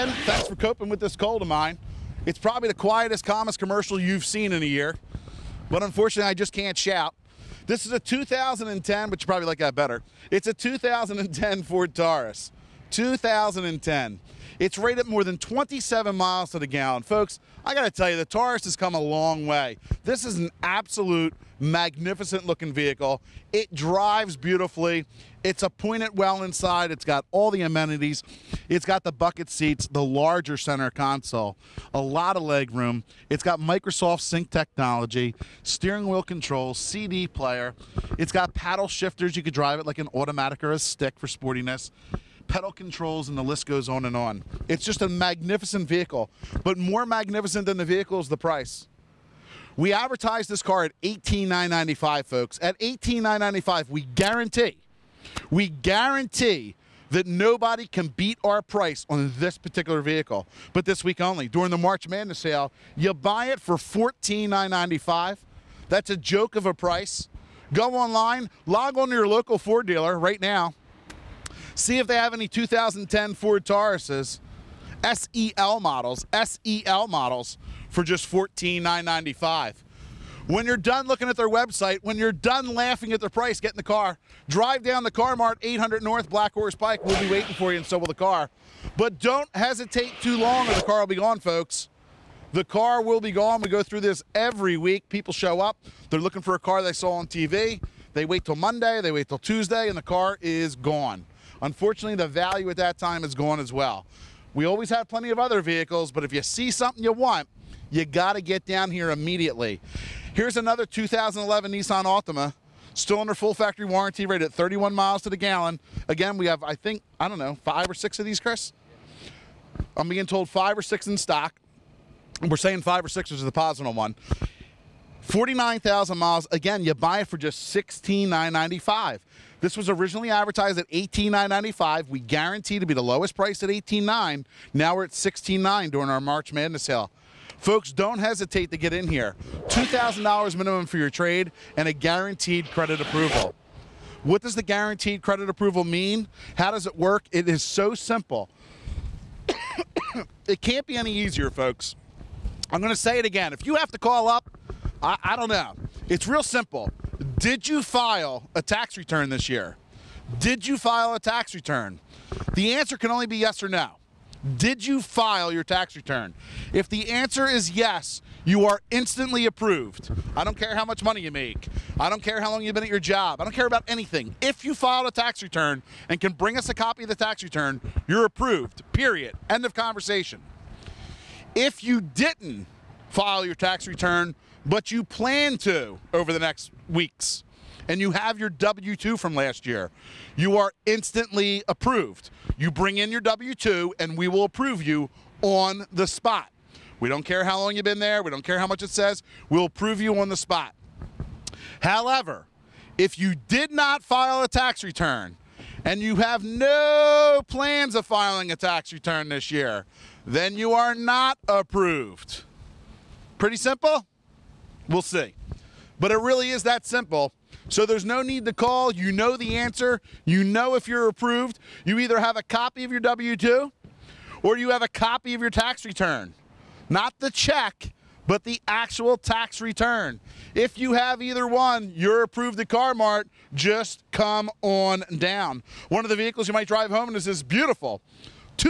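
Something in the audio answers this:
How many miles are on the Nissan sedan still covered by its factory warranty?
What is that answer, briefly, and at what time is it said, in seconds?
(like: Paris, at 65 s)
49,000, at 125 s.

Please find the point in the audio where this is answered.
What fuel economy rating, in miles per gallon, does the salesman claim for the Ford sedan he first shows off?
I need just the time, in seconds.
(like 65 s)
15 s.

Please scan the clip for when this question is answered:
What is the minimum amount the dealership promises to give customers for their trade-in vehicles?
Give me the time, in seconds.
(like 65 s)
139 s.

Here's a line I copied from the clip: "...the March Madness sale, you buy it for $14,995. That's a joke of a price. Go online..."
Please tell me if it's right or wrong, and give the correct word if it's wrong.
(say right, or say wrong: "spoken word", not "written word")
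right.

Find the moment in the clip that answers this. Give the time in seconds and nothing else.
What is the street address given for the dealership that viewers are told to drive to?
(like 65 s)
85 s.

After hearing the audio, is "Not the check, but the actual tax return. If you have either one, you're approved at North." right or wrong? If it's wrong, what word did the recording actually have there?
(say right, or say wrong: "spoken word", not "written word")
wrong: "CarMart", not "North".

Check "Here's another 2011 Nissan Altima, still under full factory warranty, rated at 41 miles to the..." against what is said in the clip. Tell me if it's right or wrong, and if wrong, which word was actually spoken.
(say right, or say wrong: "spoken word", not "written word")
wrong: "31", not "41".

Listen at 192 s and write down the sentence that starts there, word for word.
You bring in your W 2 and we will approve you on the spot.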